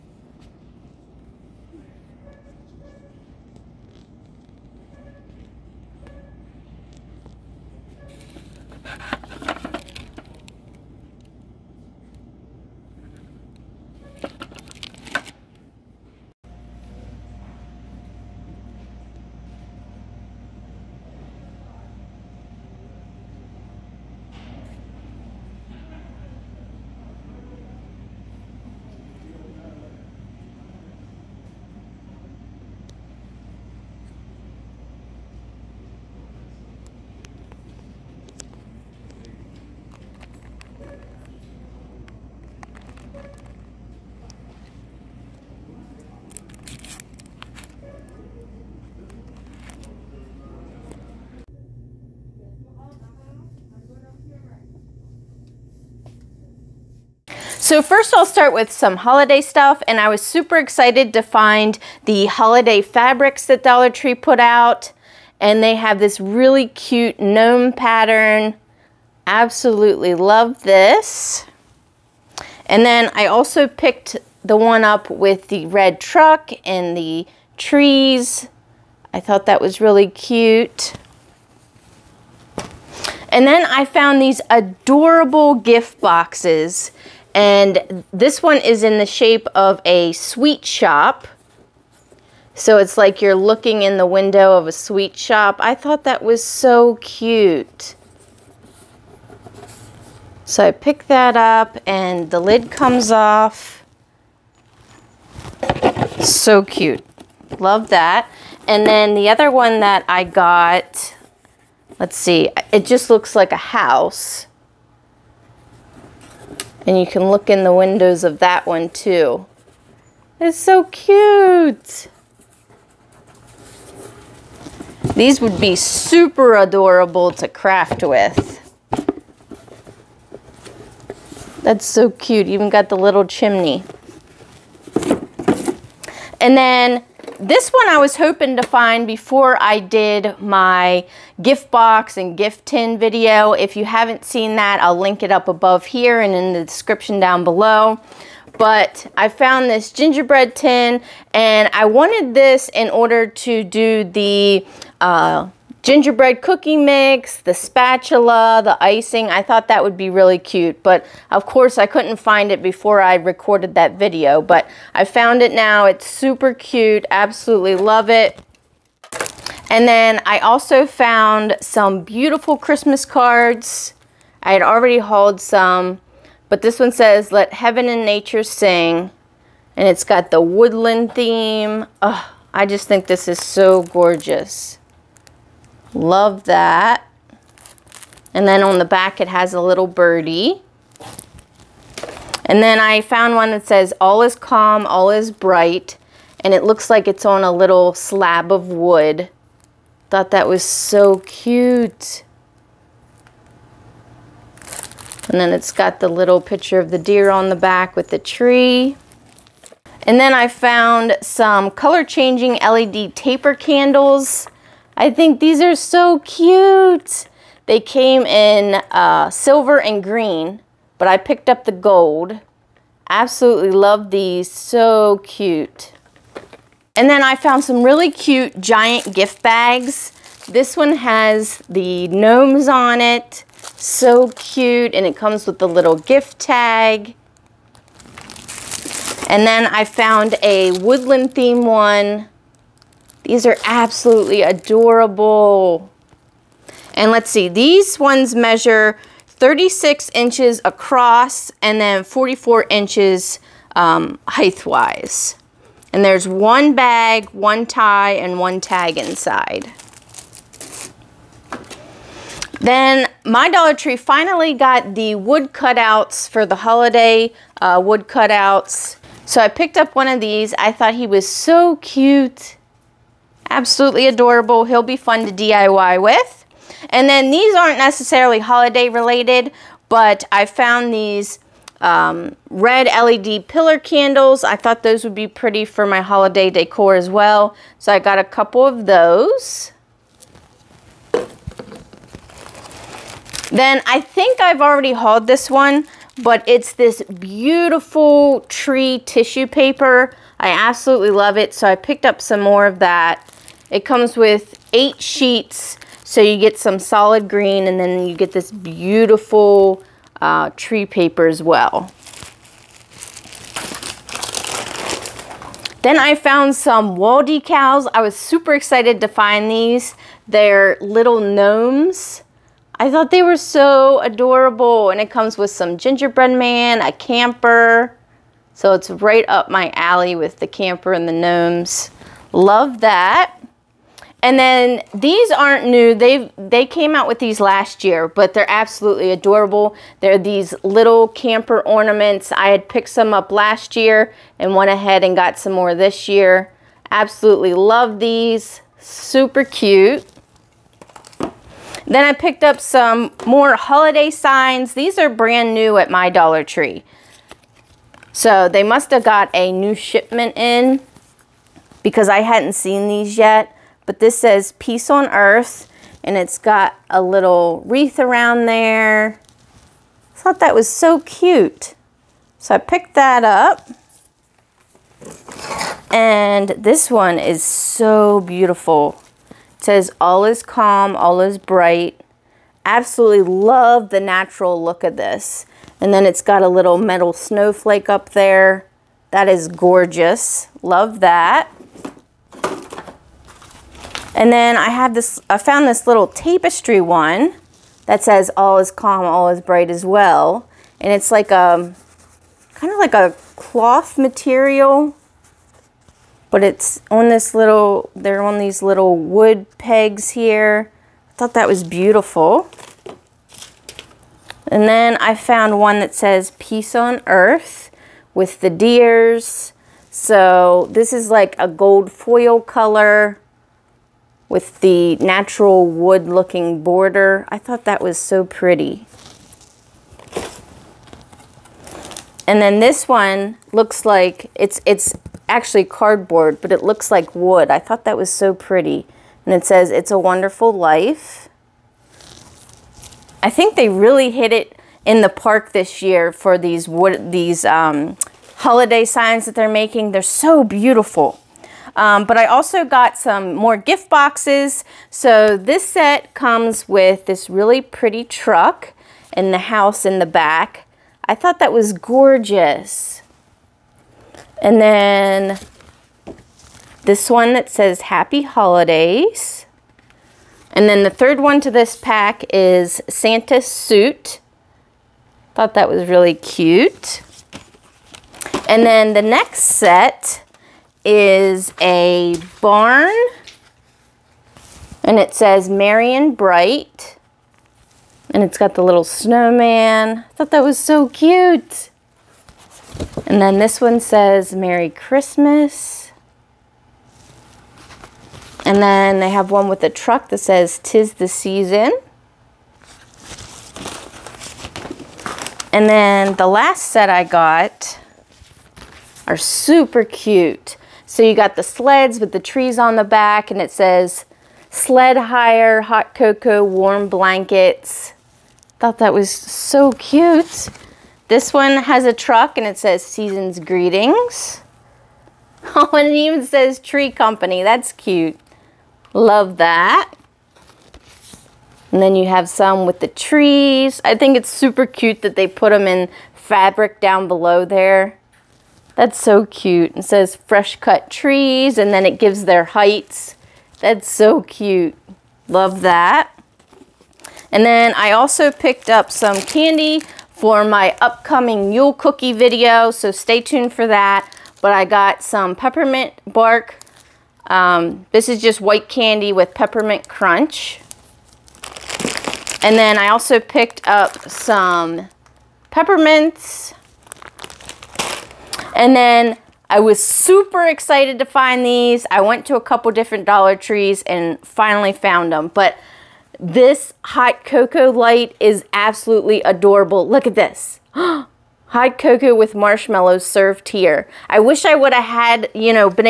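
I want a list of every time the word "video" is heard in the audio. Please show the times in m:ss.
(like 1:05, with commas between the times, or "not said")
2:22, 2:43, 9:12.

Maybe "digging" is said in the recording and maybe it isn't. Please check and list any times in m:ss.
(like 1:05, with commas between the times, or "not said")
not said.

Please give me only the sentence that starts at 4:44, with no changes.
I thought those would be pretty for my holiday decor as well.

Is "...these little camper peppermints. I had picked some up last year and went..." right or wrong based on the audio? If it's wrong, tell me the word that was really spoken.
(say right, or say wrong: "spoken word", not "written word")
wrong: "ornaments", not "peppermints".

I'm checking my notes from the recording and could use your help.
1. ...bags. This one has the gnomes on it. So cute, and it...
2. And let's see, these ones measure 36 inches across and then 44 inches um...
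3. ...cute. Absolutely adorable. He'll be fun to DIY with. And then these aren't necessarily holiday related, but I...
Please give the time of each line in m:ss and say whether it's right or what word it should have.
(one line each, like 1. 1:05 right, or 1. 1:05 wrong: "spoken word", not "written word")
1. 3:49 right
2. 4:06 right
3. 4:31 right.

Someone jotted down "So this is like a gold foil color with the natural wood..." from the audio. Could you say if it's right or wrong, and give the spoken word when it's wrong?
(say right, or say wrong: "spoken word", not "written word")
right.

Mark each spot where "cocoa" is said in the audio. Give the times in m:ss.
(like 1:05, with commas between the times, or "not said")
8:35, 9:37, 9:41.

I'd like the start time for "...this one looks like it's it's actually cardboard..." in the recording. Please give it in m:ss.
7:12.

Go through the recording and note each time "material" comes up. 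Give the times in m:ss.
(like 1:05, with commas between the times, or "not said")
6:43.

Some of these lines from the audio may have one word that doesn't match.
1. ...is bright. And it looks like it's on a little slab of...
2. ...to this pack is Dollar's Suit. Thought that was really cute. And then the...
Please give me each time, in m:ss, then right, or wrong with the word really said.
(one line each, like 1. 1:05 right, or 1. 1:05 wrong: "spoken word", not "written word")
1. 3:15 right
2. 7:51 wrong: "Santa", not "Dollar".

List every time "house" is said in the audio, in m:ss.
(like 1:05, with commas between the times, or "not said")
1:53, 7:39.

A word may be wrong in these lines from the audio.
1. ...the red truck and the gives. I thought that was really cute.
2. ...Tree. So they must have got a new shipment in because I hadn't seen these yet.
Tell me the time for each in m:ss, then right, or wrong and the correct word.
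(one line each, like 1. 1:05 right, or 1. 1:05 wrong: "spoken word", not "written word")
1. 1:15 wrong: "trees", not "gives"
2. 5:56 right.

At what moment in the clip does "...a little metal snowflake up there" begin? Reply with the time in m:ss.
6:26.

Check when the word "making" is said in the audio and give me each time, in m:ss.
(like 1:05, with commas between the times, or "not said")
7:29.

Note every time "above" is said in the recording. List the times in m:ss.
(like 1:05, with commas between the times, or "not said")
2:25.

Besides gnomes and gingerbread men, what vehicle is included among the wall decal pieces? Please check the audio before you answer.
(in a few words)
A camper.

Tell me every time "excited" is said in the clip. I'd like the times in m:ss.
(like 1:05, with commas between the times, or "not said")
1:00, 5:18, 9:30.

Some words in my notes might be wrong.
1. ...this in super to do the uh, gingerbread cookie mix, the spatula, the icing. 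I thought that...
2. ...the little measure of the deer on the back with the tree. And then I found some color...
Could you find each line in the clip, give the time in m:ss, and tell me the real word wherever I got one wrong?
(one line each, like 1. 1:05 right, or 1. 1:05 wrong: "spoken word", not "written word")
1. 2:32 wrong: "order", not "super"
2. 3:25 wrong: "picture", not "measure".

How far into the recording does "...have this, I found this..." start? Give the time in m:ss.
6:34.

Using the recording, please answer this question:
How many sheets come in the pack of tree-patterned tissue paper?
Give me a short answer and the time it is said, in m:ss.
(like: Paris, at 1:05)
8, at 5:04.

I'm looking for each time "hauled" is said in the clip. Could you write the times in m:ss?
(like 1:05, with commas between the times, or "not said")
2:54, 4:54.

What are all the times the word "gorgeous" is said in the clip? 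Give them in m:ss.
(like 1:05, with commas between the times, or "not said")
3:03, 6:29, 7:41.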